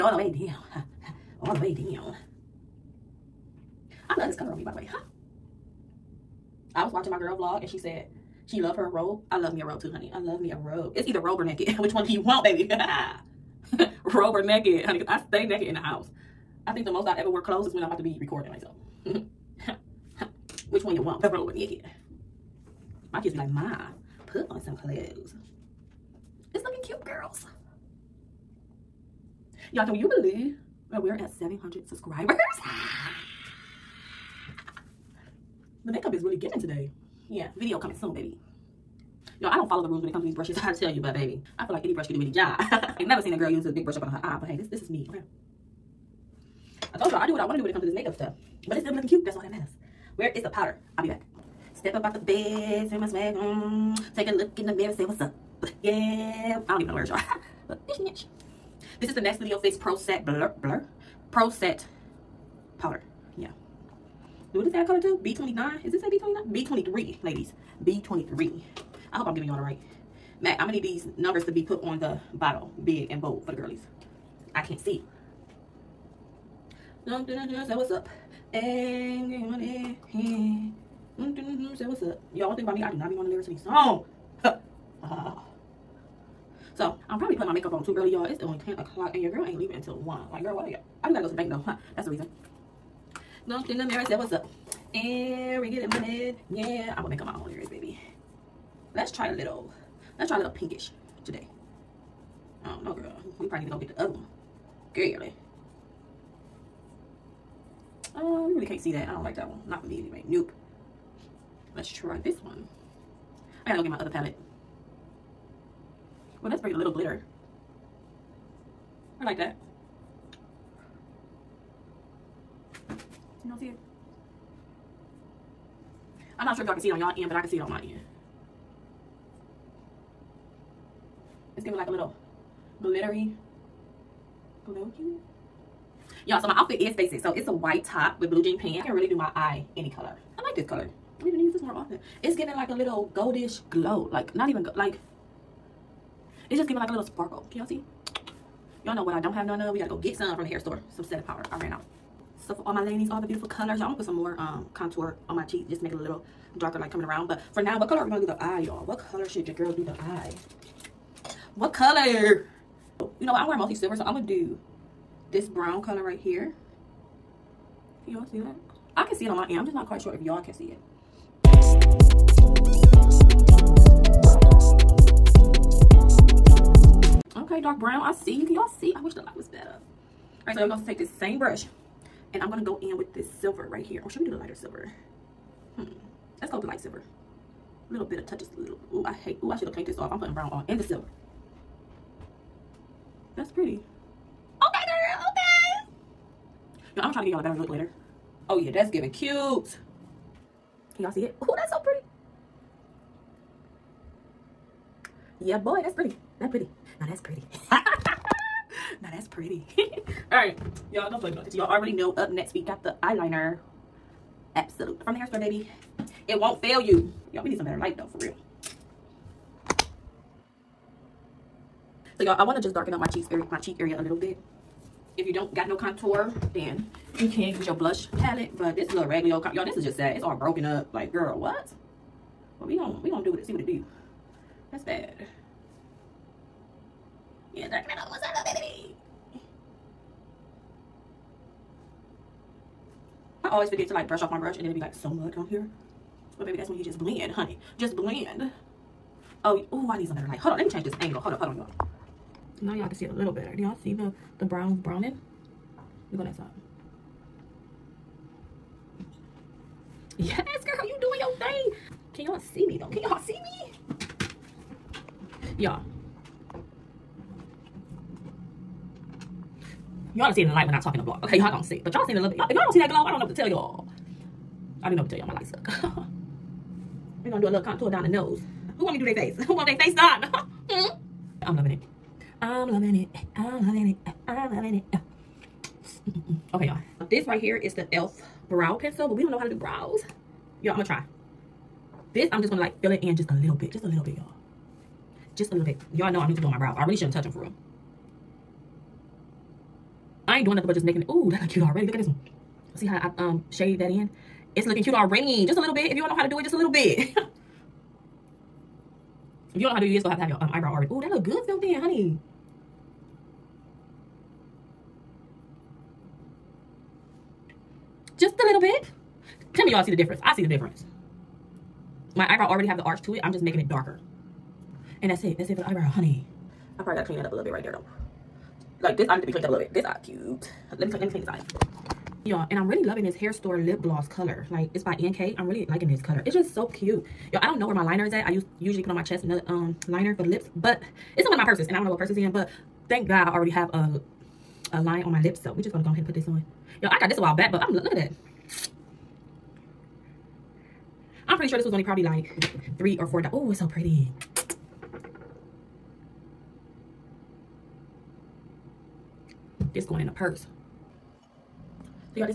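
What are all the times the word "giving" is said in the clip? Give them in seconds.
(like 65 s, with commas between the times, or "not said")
36 s, 69 s, 131 s, 142 s, 146 s, 198 s.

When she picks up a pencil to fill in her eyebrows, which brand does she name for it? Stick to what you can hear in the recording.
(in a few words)
e.l.f.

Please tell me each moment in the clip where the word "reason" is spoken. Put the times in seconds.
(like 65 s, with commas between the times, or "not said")
92 s.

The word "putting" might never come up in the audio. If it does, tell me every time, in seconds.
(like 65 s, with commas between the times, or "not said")
87 s, 190 s.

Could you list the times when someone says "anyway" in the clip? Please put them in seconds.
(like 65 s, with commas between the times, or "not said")
110 s.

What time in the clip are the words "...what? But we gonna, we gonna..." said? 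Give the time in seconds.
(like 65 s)
231 s.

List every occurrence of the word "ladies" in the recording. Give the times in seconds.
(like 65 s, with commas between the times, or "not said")
67 s, 152 s.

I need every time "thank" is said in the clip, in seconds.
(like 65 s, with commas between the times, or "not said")
342 s.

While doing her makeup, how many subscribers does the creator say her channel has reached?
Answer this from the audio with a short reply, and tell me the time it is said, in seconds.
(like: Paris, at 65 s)
700, at 31 s.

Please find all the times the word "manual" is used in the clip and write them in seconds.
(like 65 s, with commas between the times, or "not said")
not said.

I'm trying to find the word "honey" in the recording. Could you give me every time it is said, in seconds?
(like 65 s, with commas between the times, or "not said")
9 s, 14 s, 247 s, 311 s, 325 s.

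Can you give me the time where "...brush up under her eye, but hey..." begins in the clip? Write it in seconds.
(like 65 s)
43 s.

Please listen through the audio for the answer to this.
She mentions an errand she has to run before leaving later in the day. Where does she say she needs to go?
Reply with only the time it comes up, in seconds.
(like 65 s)
91 s.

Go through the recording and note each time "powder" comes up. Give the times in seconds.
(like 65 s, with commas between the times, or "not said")
50 s, 62 s, 151 s.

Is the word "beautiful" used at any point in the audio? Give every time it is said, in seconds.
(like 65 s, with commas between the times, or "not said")
153 s.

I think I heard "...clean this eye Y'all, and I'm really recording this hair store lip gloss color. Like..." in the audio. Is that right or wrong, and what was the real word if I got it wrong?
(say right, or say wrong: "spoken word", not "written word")
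wrong: "loving", not "recording".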